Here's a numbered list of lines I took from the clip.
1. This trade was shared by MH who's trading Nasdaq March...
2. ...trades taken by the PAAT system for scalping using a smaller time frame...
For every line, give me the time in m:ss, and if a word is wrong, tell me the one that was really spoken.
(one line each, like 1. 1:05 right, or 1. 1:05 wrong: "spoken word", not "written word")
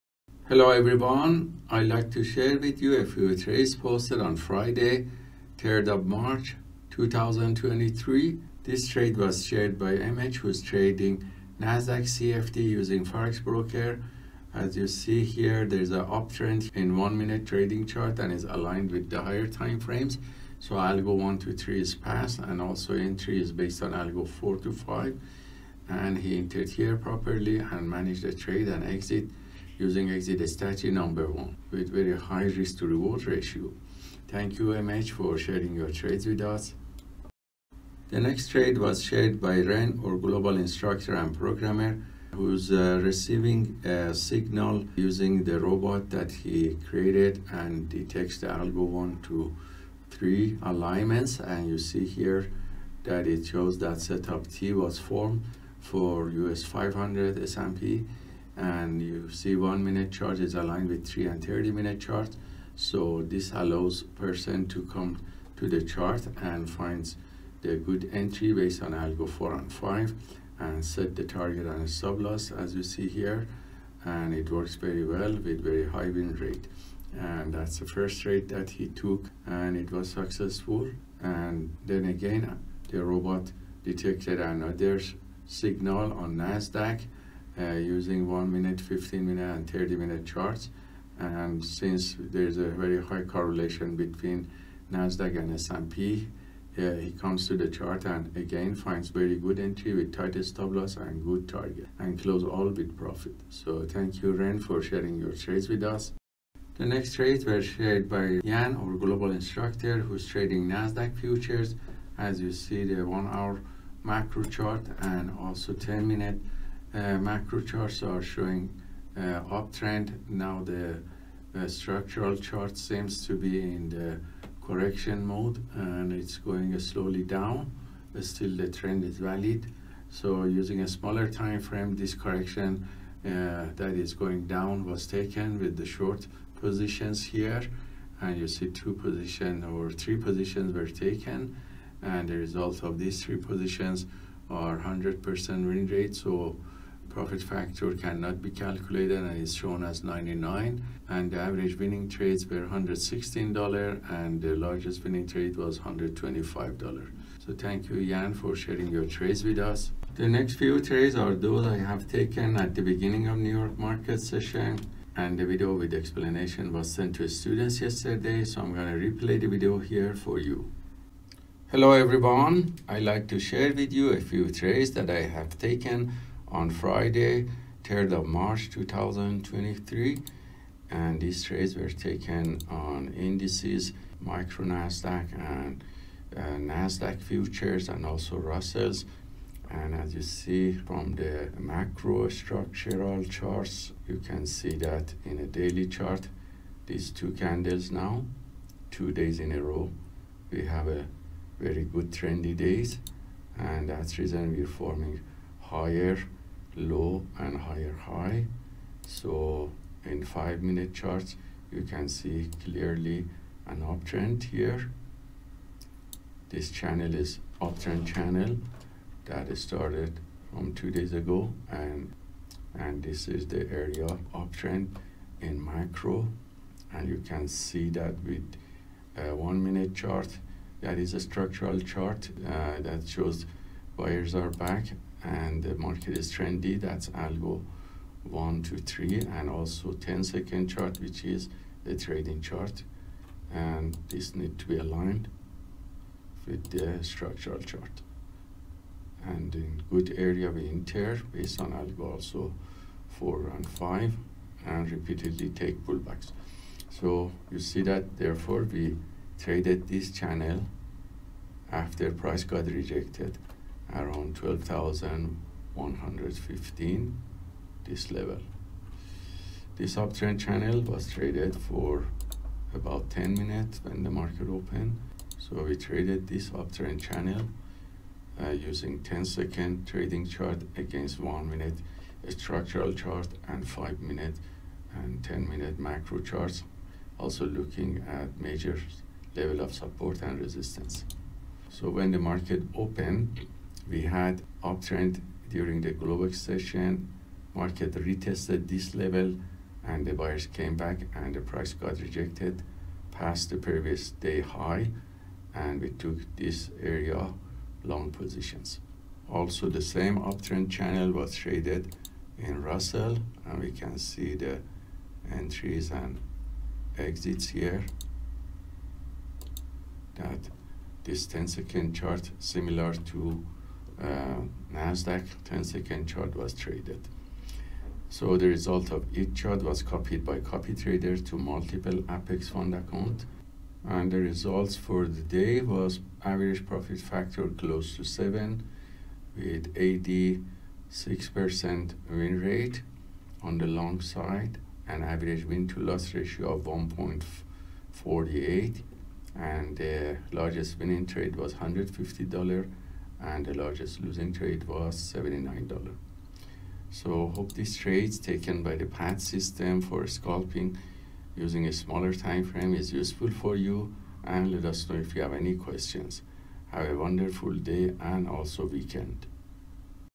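1. 0:08 wrong: "CFD", not "March"
2. 5:57 right.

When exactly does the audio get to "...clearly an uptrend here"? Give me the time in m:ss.
3:32.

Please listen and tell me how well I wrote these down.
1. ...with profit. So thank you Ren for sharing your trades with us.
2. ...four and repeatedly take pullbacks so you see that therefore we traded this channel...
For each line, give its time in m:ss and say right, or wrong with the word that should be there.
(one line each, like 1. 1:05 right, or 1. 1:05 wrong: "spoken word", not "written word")
1. 1:42 right
2. 4:13 wrong: "five", not "four".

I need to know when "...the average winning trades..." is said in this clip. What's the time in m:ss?
2:31.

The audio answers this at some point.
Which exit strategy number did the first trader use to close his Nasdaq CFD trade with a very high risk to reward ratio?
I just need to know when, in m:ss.
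0:30.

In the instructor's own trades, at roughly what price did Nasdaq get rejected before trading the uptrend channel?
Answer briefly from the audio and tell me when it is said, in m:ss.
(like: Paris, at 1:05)
12,115, at 4:24.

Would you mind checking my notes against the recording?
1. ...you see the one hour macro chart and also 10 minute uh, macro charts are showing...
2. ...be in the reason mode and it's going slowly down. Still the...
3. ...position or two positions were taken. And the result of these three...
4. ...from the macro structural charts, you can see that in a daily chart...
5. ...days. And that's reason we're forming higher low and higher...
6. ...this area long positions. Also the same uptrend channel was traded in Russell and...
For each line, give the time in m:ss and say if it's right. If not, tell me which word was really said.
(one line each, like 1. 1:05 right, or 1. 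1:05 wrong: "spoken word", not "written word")
1. 1:52 right
2. 2:03 wrong: "correction", not "reason"
3. 2:18 wrong: "three", not "two"
4. 3:10 right
5. 3:22 right
6. 5:06 right.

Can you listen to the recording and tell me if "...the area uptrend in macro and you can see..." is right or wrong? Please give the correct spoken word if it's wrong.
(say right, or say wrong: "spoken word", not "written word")
right.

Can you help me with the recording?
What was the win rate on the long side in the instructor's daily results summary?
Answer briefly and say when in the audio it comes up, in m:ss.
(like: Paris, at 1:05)
86%, at 5:39.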